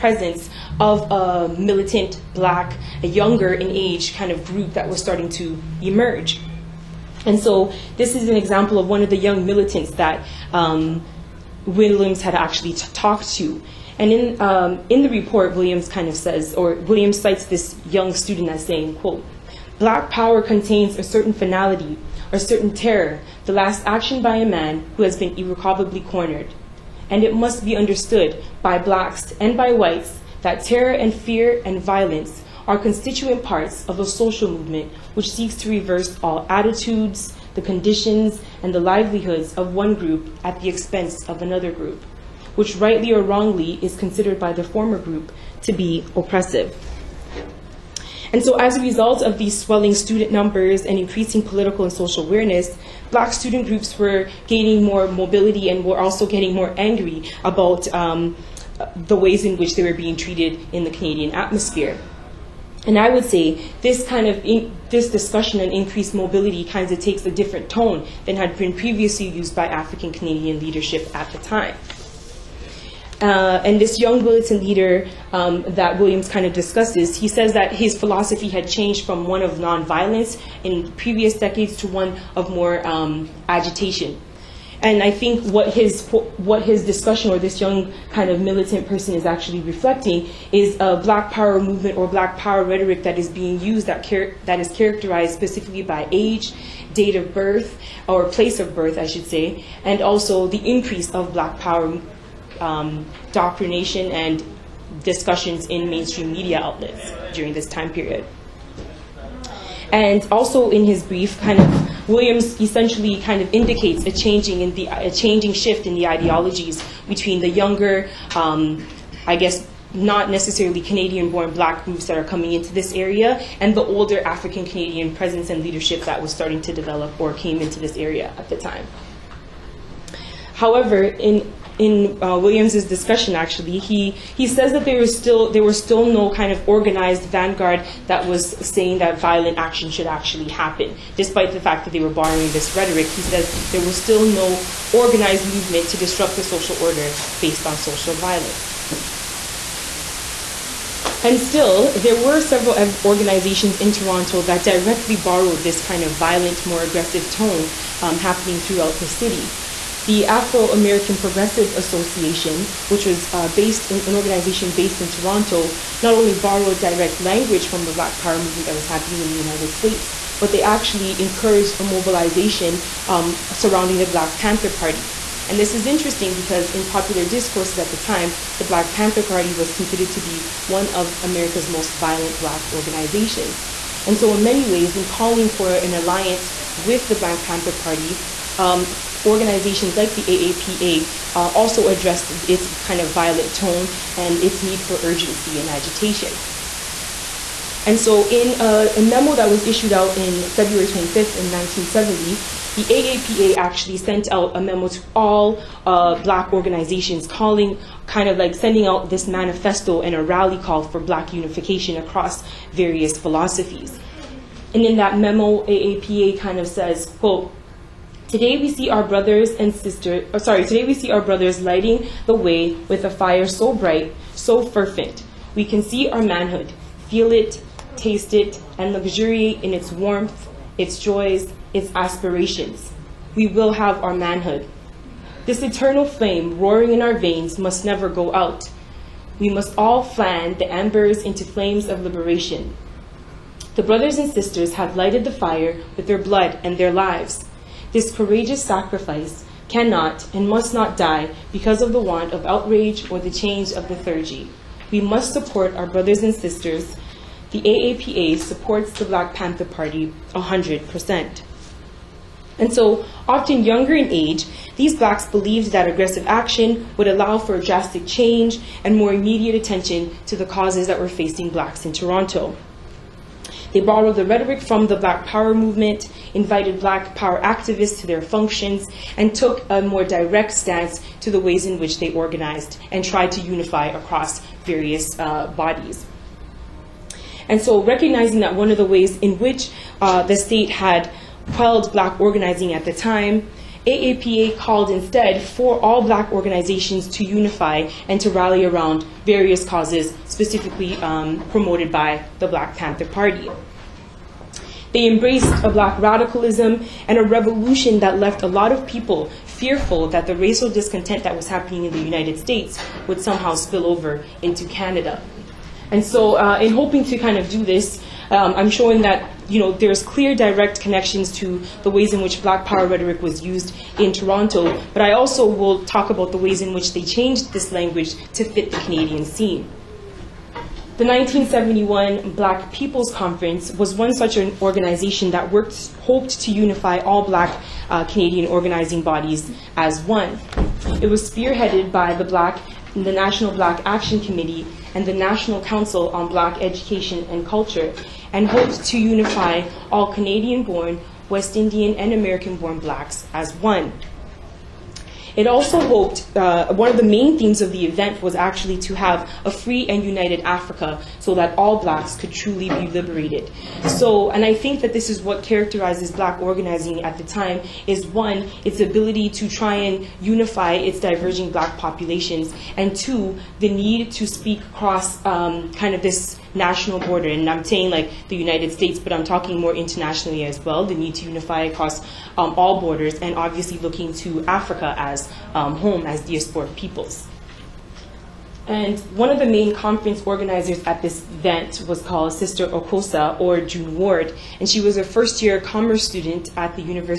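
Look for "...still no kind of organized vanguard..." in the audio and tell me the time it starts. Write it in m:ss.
2:15.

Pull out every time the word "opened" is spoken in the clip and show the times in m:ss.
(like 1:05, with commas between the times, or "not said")
not said.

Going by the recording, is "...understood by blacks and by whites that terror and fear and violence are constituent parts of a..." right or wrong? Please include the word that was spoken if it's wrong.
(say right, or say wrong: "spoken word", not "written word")
right.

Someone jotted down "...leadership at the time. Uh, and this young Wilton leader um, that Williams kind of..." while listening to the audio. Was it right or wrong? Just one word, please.
right.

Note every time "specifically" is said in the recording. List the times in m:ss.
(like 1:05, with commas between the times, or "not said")
1:35, 5:00.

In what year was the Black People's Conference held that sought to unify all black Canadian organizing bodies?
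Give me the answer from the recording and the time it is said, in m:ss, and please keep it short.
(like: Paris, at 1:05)
1971, at 5:31.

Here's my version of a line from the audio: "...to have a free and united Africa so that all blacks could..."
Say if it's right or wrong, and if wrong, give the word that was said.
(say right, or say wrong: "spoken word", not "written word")
right.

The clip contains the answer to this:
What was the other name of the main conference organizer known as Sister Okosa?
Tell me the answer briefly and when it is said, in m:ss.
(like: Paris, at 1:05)
June Ward, at 6:33.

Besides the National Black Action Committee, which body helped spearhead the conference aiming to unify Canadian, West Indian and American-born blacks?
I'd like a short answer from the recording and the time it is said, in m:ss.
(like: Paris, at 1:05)
National Council on Black Education and Culture, at 5:45.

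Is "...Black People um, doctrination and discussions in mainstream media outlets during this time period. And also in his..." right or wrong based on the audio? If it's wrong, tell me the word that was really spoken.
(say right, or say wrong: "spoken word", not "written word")
wrong: "Power", not "People".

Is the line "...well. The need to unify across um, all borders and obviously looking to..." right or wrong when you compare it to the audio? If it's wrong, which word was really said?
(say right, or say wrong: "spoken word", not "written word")
right.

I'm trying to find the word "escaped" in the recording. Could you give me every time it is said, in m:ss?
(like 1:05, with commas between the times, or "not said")
not said.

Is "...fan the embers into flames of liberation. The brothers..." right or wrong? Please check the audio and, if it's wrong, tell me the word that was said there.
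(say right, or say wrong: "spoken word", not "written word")
right.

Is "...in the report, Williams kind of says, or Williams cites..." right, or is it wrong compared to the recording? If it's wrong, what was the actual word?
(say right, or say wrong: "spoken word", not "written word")
right.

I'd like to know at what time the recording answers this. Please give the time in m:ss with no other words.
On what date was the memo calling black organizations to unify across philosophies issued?
3:20.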